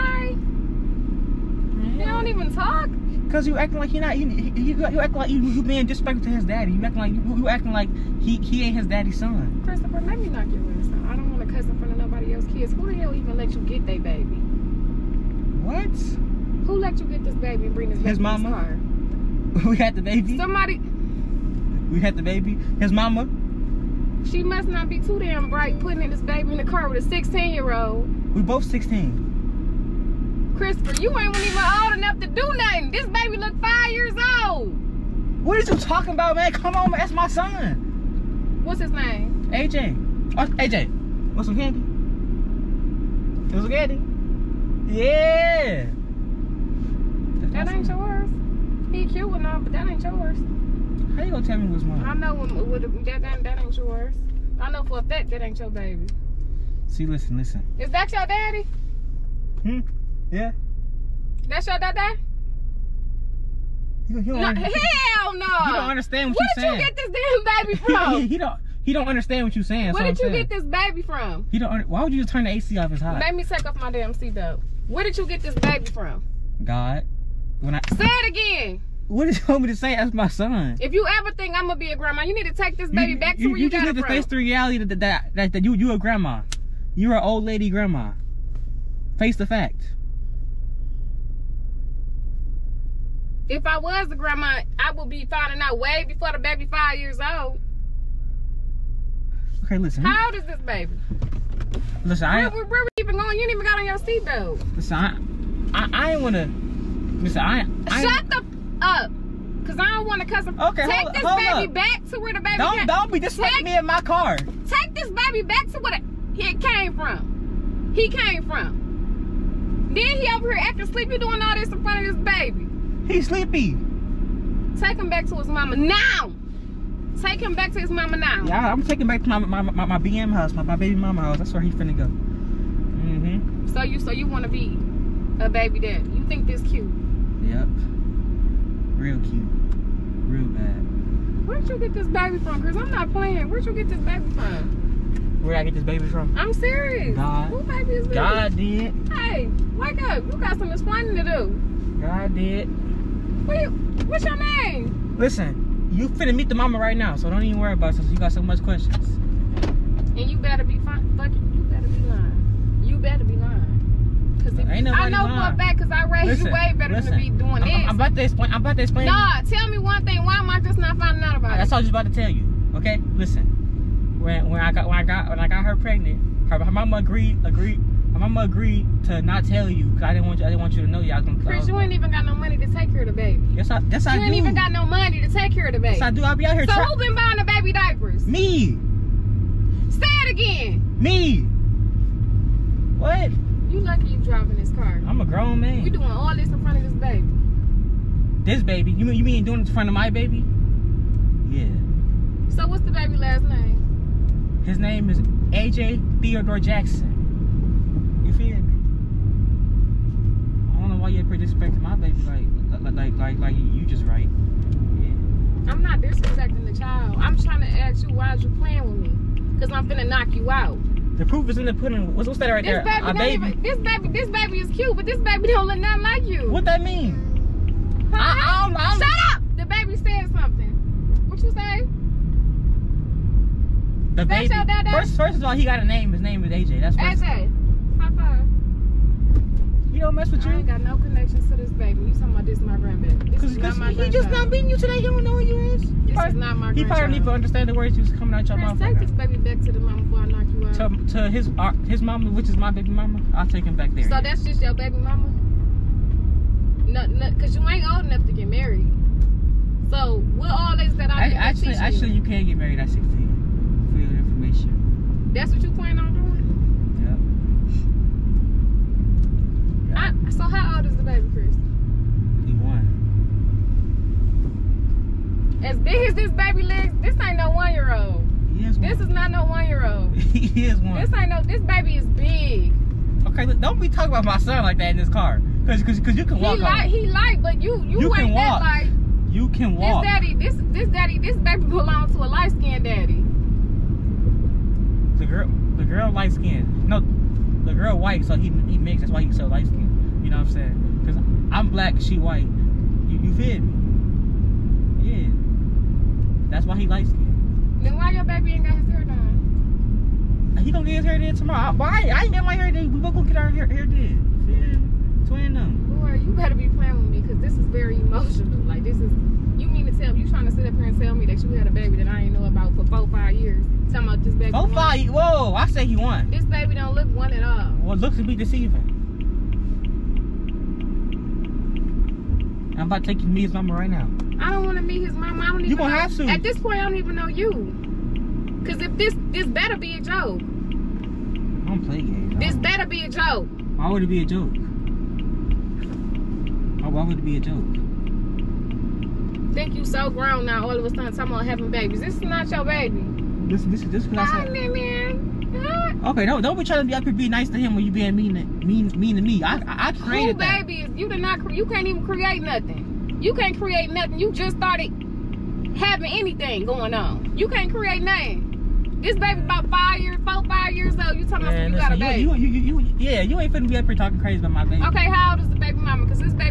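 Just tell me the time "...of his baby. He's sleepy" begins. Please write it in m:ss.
2:02.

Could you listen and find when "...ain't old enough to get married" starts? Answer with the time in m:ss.
4:17.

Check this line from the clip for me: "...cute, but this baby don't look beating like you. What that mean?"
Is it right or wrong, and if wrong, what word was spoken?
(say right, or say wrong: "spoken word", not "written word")
wrong: "nothing", not "beating".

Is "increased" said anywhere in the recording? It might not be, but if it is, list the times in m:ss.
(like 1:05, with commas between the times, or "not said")
not said.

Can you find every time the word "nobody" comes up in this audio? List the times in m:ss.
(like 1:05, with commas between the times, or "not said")
0:11.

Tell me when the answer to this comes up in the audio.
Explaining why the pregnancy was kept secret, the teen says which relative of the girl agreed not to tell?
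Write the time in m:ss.
2:56.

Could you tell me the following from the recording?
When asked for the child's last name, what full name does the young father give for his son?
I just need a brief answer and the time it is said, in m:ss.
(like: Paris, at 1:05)
AJ Theodore Jackson, at 3:25.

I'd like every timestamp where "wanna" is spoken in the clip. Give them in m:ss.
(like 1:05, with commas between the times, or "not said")
1:46, 2:14.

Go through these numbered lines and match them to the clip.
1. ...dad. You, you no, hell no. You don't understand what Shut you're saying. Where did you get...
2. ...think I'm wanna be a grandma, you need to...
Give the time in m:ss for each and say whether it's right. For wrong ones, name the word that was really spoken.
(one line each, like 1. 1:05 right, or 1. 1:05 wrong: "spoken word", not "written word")
1. 1:01 wrong: "Where", not "Shut"
2. 1:21 wrong: "gonna", not "wanna".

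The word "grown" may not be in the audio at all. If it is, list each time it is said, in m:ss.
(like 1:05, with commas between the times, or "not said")
3:15, 5:50.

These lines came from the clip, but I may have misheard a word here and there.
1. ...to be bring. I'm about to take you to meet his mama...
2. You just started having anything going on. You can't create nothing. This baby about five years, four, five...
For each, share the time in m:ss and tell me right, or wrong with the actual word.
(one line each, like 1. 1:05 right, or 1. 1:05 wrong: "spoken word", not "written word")
1. 5:28 wrong: "deceiving", not "bring"
2. 6:04 right.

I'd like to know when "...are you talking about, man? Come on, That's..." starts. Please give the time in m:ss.
0:35.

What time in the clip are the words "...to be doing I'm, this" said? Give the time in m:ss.
2:47.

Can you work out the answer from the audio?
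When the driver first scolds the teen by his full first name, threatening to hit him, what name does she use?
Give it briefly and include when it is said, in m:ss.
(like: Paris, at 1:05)
Christopher, at 0:09.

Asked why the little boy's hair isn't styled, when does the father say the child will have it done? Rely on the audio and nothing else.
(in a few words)
Tomorrow.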